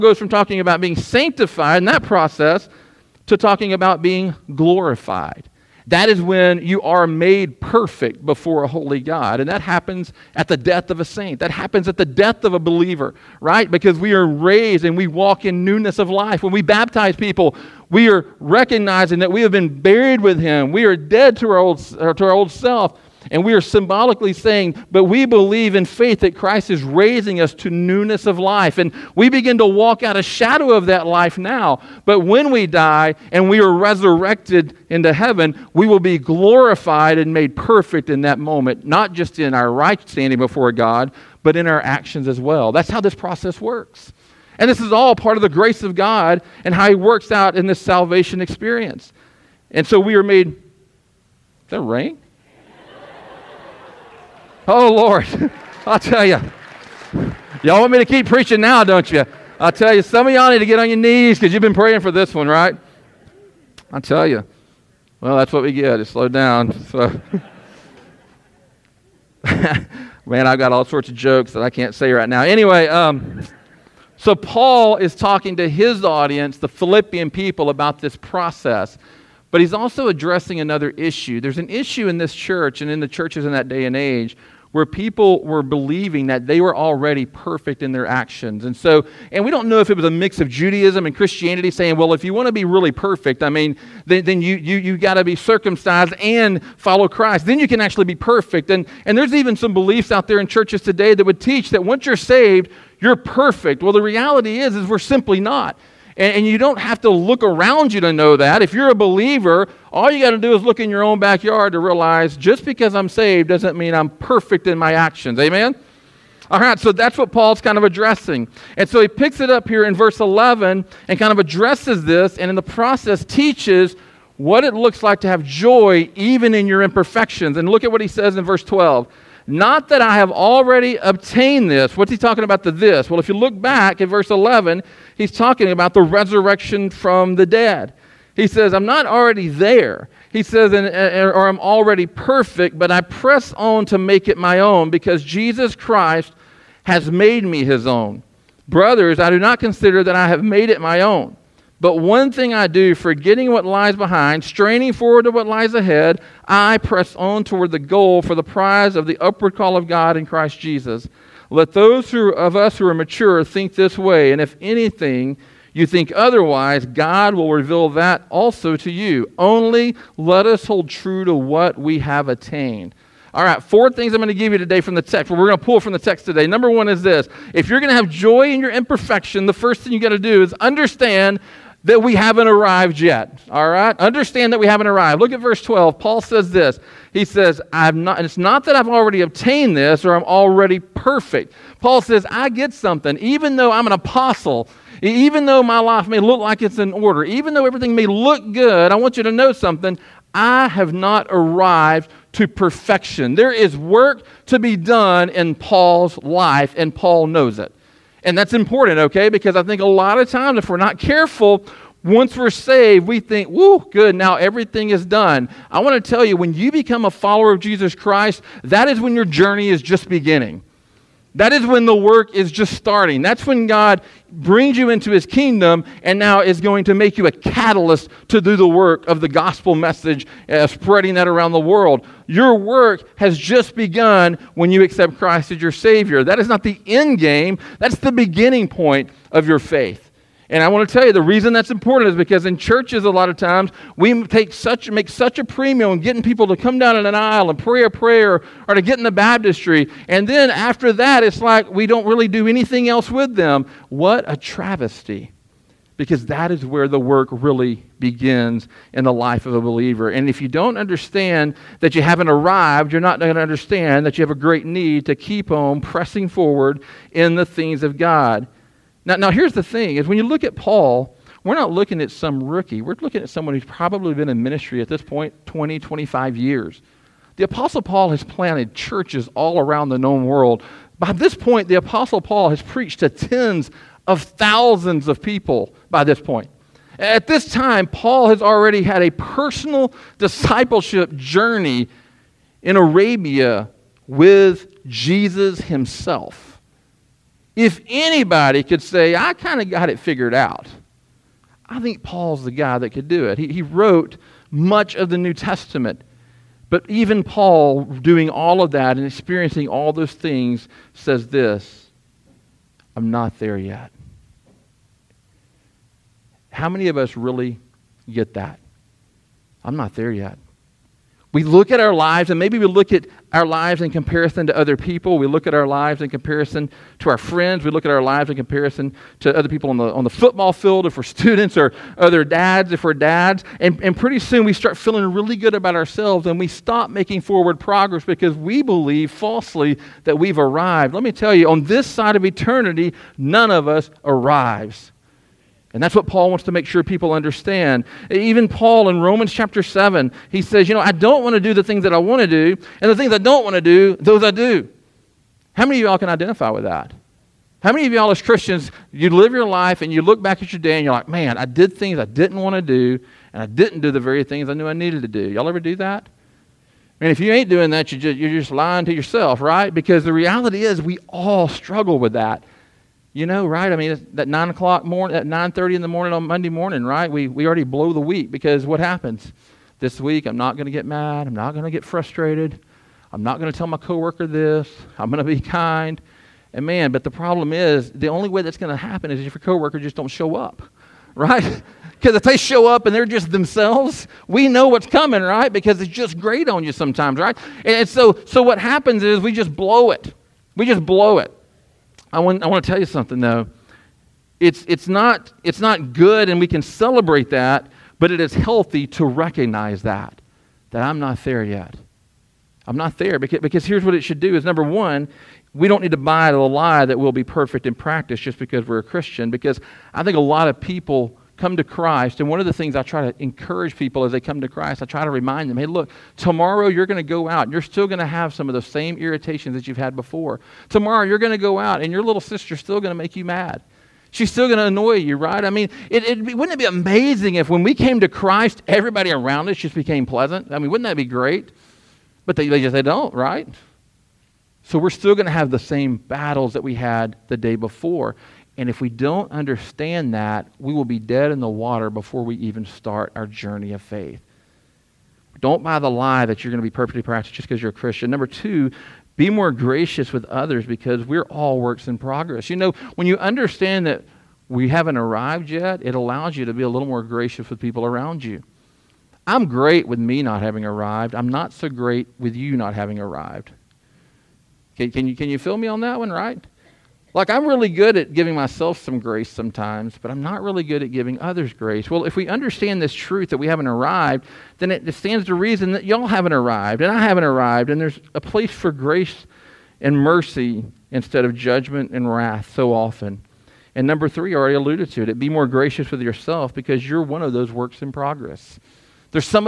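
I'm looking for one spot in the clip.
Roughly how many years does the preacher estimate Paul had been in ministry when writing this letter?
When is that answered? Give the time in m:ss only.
4:35.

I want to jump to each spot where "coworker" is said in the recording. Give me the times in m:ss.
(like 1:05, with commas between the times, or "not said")
6:23, 6:29.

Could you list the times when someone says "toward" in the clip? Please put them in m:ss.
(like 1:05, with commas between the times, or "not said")
2:37.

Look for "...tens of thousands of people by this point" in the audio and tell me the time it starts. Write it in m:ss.
4:43.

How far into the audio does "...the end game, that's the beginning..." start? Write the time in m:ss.
3:56.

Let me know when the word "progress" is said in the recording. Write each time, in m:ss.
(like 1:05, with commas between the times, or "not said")
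5:37, 7:41, 8:17.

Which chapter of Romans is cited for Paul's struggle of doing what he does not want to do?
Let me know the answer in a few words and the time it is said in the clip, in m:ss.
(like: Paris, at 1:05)
Chapter 7, at 5:49.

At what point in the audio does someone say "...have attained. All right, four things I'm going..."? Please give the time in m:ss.
2:51.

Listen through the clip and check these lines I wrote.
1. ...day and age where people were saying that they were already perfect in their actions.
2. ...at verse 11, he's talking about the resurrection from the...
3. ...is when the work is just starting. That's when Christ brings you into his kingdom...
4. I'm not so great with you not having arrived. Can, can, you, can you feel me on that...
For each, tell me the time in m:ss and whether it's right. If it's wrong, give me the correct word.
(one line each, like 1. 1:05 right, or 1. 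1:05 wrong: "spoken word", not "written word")
1. 1:23 wrong: "believing", not "saying"
2. 2:13 right
3. 3:41 wrong: "God", not "Christ"
4. 7:51 right.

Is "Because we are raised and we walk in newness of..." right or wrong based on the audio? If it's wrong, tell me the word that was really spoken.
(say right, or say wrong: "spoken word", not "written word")
right.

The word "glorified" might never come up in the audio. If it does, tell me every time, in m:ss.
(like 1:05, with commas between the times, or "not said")
0:04, 0:36.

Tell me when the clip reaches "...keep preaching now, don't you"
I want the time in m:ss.
0:58.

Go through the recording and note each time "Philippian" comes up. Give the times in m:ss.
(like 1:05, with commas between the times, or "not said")
1:16.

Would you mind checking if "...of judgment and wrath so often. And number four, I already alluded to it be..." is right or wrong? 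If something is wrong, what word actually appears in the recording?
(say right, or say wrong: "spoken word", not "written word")
wrong: "three", not "four".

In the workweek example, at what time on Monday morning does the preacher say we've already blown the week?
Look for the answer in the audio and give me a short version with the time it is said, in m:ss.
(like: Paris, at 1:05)
9:30, at 6:15.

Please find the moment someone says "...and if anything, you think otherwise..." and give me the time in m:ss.
2:44.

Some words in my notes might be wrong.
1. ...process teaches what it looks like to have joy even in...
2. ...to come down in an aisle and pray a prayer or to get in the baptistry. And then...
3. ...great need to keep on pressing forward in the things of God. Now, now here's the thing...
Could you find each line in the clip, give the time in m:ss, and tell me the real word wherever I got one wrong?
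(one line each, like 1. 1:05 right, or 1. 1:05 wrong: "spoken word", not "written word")
1. 2:02 right
2. 4:06 right
3. 4:24 right.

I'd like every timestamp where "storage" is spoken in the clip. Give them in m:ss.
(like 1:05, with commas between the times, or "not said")
not said.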